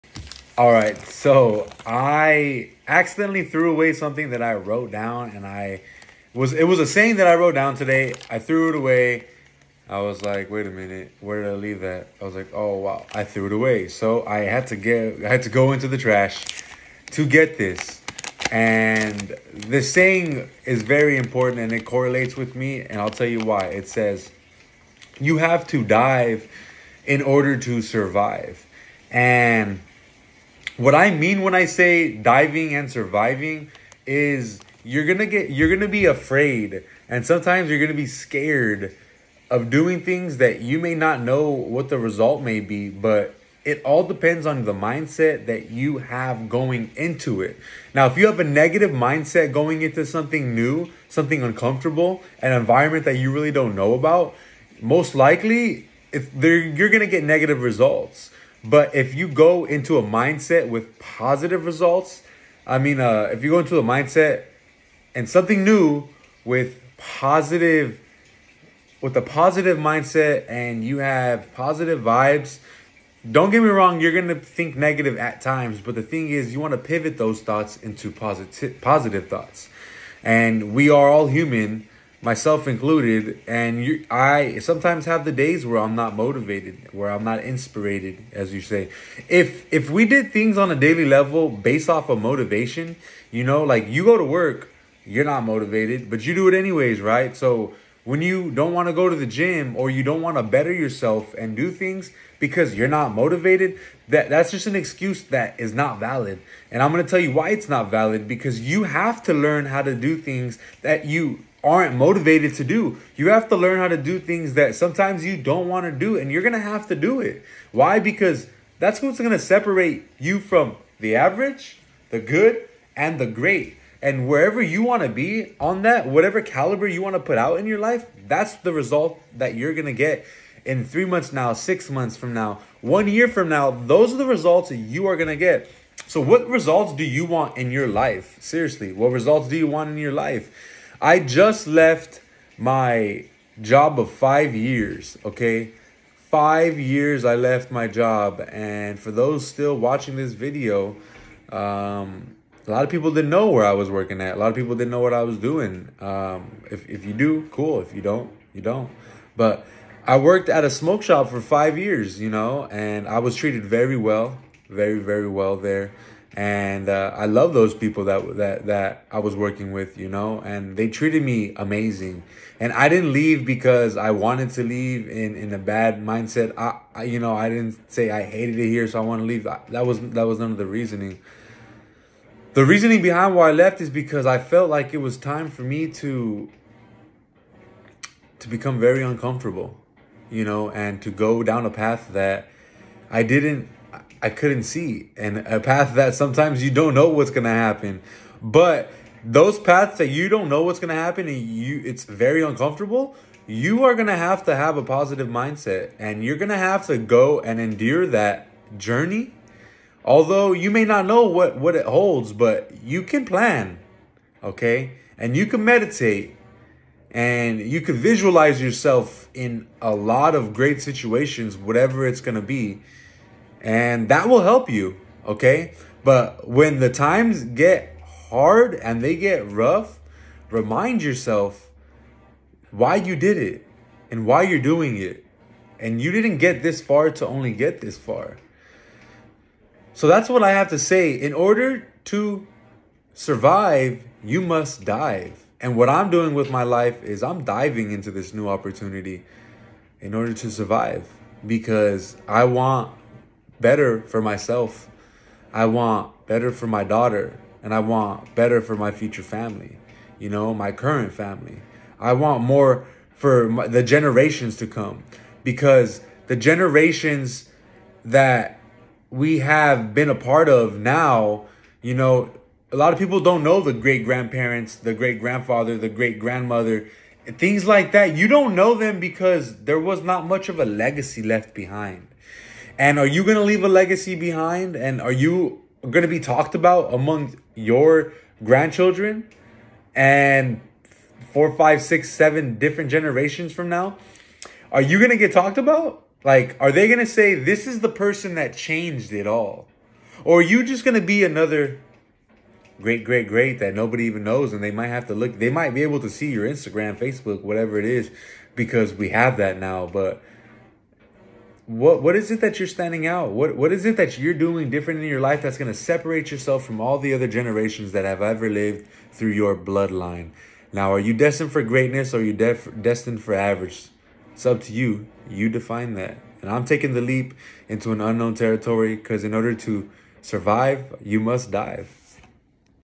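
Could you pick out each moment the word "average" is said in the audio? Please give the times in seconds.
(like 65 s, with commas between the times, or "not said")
121 s, 323 s.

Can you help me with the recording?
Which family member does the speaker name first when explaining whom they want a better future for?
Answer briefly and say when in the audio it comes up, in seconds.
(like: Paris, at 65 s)
Daughter, at 256 s.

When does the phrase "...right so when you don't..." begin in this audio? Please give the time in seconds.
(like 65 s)
97 s.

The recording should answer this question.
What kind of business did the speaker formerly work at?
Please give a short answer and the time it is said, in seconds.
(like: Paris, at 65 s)
Smoke shop, at 160 s.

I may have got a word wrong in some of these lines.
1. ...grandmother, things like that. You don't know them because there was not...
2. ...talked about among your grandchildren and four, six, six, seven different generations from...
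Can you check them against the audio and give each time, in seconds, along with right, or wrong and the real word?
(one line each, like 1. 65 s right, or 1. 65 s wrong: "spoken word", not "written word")
1. 276 s right
2. 286 s wrong: "five", not "six".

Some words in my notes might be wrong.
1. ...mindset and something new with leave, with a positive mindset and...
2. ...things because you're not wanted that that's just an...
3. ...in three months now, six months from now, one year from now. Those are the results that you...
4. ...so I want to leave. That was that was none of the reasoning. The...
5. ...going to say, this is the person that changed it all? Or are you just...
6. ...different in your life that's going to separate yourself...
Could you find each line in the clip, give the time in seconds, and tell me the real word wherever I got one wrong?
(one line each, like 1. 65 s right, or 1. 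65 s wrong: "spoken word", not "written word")
1. 63 s wrong: "positive", not "leave"
2. 101 s wrong: "motivated", not "wanted"
3. 130 s right
4. 178 s right
5. 296 s right
6. 314 s right.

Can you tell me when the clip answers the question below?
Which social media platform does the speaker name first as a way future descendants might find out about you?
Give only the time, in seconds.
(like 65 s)
306 s.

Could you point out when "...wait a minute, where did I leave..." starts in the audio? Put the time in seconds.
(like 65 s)
10 s.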